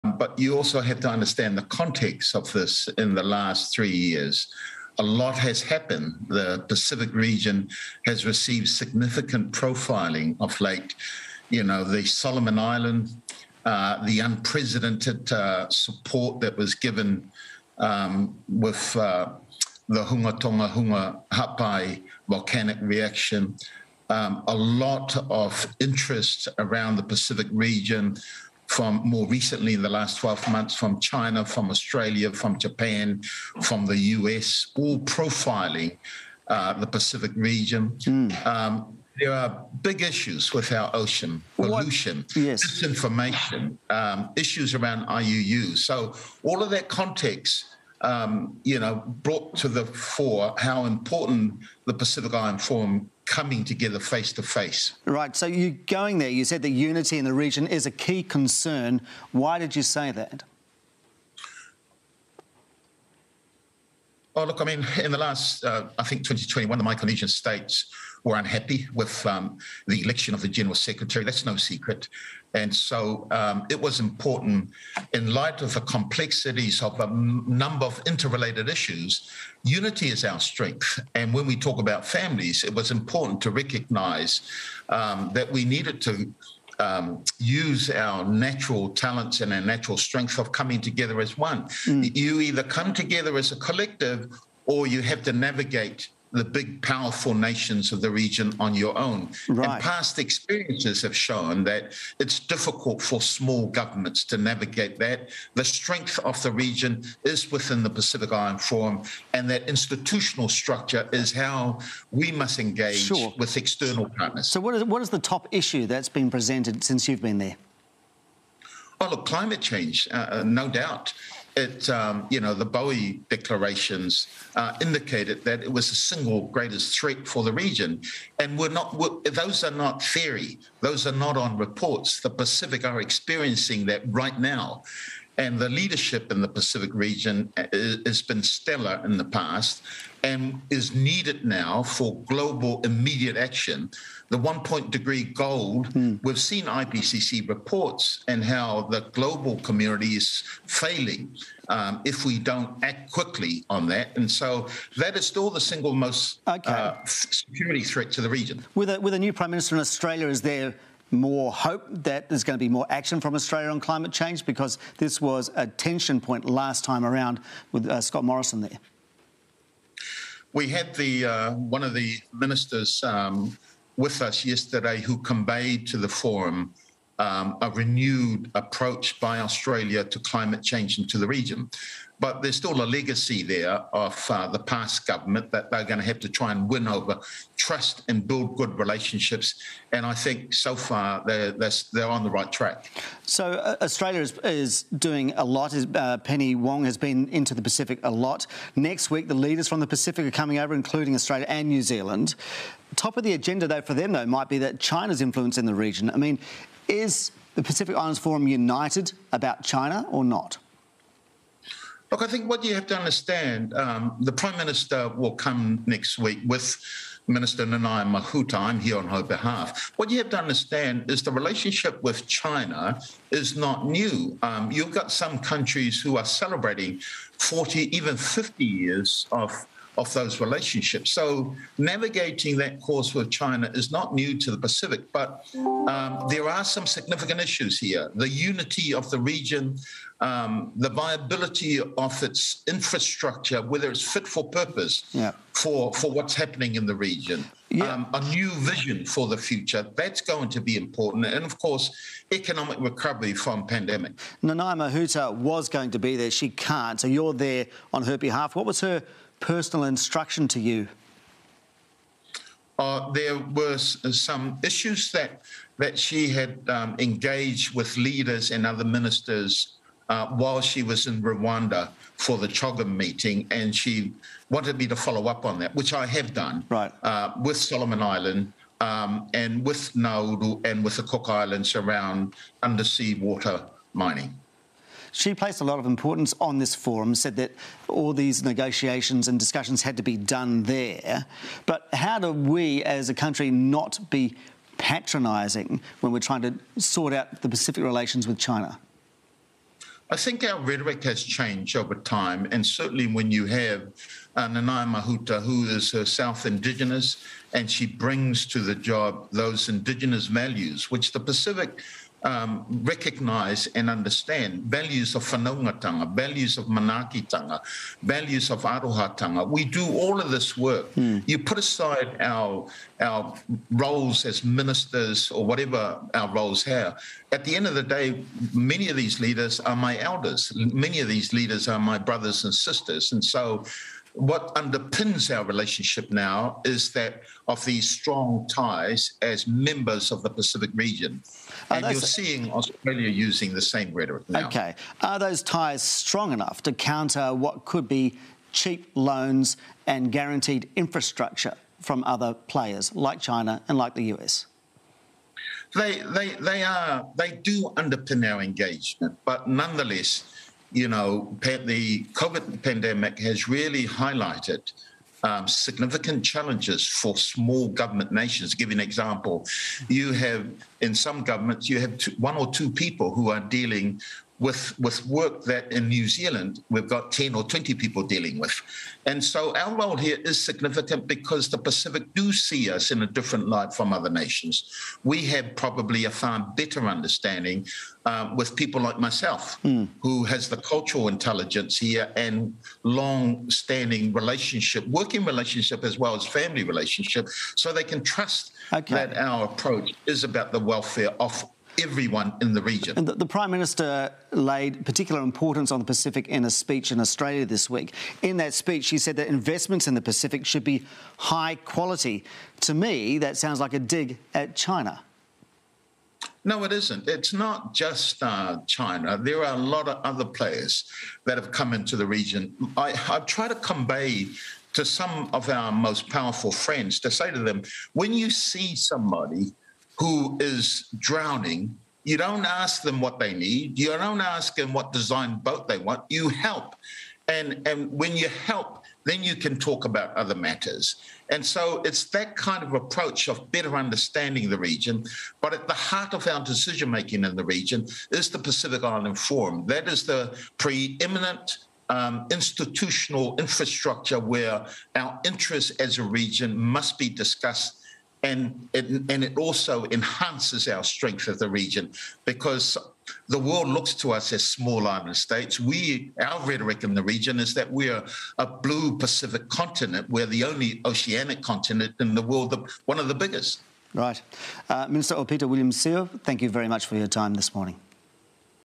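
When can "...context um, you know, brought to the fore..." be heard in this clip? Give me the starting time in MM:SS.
00:46.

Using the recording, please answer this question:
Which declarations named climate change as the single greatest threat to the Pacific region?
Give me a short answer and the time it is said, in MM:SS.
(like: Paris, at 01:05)
Boe declarations, at 02:02.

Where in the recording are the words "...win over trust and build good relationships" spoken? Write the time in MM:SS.
03:06.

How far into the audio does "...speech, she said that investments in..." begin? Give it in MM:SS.
06:48.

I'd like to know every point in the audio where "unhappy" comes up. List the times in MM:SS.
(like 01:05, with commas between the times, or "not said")
01:08.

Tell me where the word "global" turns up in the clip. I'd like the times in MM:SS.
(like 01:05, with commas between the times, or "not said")
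02:22, 02:29.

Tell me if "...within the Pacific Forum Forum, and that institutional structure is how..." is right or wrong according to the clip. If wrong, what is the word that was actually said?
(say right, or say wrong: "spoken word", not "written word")
wrong: "Island", not "Forum".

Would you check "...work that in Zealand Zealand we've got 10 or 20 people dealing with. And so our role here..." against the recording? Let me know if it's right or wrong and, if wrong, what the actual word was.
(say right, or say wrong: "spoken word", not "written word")
wrong: "New", not "Zealand".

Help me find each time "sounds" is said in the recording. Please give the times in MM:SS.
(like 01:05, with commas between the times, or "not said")
06:53.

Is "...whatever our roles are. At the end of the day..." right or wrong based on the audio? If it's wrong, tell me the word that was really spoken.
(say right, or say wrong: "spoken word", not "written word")
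right.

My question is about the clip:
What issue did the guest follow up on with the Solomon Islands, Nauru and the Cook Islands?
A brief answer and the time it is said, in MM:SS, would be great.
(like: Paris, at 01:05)
Undersea water mining, at 04:42.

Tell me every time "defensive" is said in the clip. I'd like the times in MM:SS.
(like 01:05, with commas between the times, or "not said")
not said.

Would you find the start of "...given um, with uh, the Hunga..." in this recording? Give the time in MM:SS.
00:16.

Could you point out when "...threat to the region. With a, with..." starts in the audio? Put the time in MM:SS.
02:37.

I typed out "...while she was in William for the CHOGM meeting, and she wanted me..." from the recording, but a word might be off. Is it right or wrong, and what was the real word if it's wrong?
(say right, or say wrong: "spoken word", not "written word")
wrong: "Rwanda", not "William".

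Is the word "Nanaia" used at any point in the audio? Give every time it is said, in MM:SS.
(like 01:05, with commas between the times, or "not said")
03:37, 04:14, 05:04.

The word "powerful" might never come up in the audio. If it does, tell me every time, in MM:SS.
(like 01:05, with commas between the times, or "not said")
01:36, 07:06.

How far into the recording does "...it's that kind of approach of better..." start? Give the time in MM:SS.
07:21.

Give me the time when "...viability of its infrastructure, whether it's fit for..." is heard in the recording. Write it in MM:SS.
04:00.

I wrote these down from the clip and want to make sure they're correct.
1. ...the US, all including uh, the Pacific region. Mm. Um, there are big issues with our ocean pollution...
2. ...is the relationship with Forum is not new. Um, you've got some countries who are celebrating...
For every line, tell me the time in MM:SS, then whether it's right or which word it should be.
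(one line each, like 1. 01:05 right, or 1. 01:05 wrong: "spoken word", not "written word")
1. 00:33 wrong: "profiling", not "including"
2. 03:41 wrong: "China", not "Forum".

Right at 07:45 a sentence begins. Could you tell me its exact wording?
We, our rhetoric in the region is that we're a blue Pacific continent.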